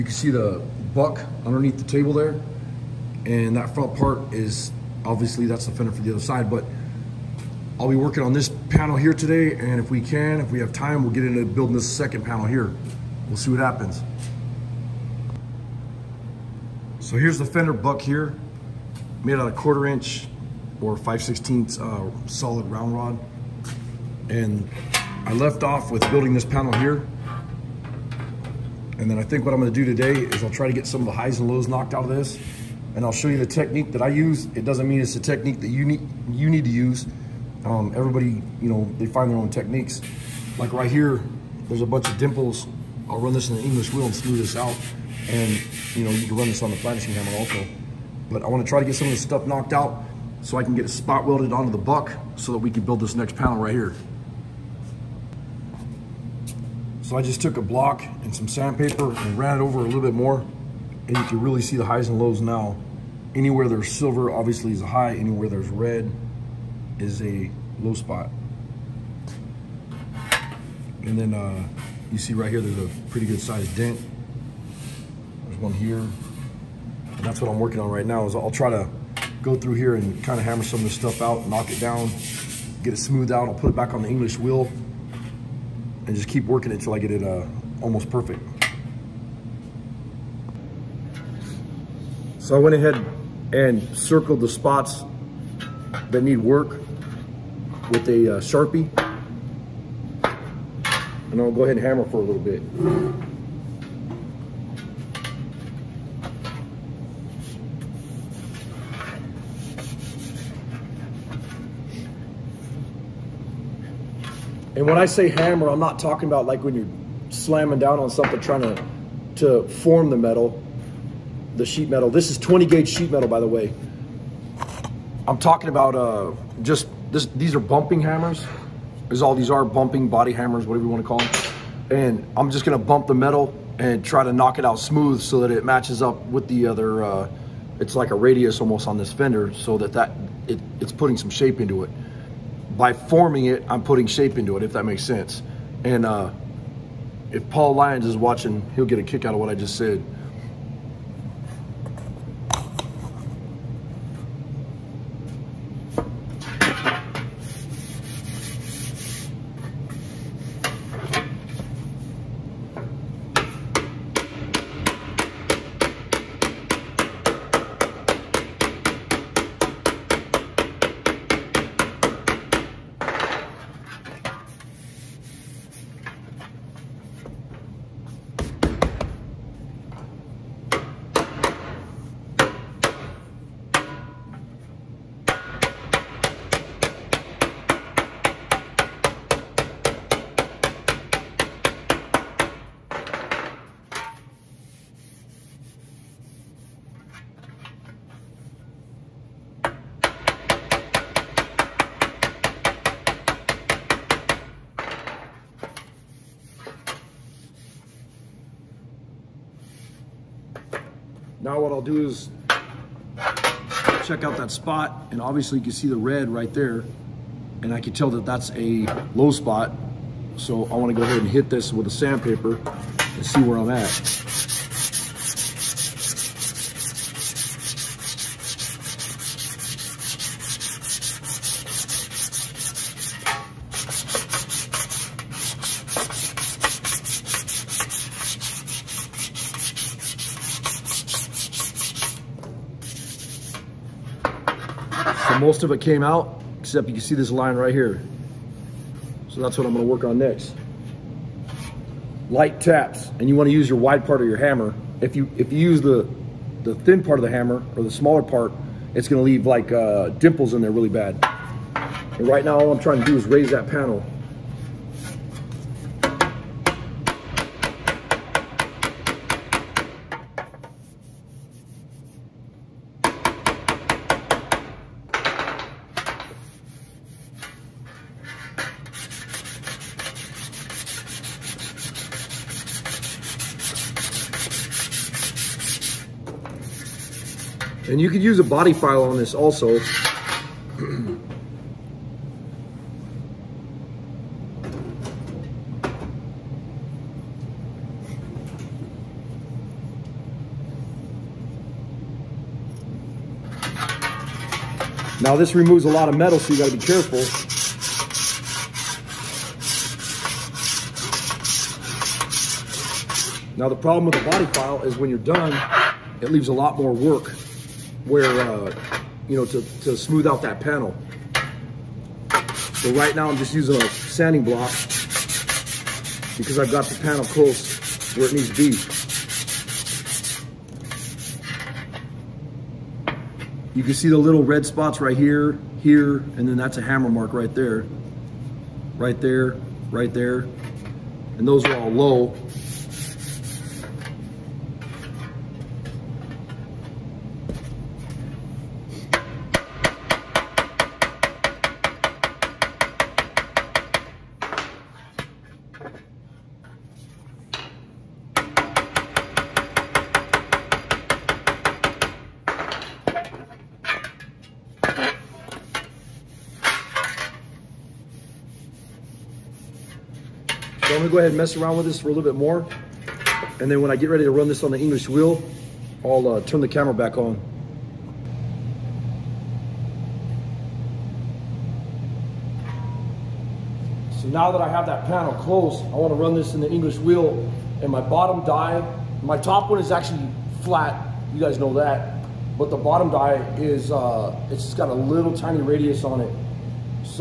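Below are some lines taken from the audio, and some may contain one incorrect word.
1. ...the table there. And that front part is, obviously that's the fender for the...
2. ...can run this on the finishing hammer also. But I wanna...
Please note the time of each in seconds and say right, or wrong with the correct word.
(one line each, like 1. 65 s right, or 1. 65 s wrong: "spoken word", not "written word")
1. 1 s right
2. 46 s right.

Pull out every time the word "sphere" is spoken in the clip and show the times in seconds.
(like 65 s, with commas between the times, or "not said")
not said.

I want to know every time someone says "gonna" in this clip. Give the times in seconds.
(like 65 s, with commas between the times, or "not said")
29 s, 132 s, 249 s, 259 s, 371 s.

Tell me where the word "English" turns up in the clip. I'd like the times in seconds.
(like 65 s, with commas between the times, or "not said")
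43 s, 84 s, 374 s, 386 s.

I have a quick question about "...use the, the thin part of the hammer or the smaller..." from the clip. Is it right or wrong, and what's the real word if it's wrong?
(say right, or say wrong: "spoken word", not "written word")
right.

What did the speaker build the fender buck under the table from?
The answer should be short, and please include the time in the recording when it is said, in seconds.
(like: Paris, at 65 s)
Solid round rod, at 22 s.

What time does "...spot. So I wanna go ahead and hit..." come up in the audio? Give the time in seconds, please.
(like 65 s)
219 s.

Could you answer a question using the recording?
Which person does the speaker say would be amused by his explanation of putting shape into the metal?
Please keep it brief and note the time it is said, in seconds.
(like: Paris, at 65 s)
Paul Lyons, at 147 s.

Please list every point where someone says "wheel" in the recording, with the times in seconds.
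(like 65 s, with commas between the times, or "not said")
43 s, 84 s, 375 s, 386 s.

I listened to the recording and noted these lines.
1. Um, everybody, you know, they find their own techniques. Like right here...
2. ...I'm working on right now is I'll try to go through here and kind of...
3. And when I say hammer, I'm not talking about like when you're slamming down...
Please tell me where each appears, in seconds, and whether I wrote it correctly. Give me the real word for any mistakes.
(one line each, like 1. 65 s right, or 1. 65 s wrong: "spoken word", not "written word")
1. 37 s right
2. 77 s right
3. 114 s right.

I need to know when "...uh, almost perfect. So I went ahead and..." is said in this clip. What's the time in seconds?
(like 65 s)
87 s.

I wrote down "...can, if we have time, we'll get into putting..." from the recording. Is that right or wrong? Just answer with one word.
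wrong.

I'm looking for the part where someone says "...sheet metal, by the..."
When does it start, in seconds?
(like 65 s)
122 s.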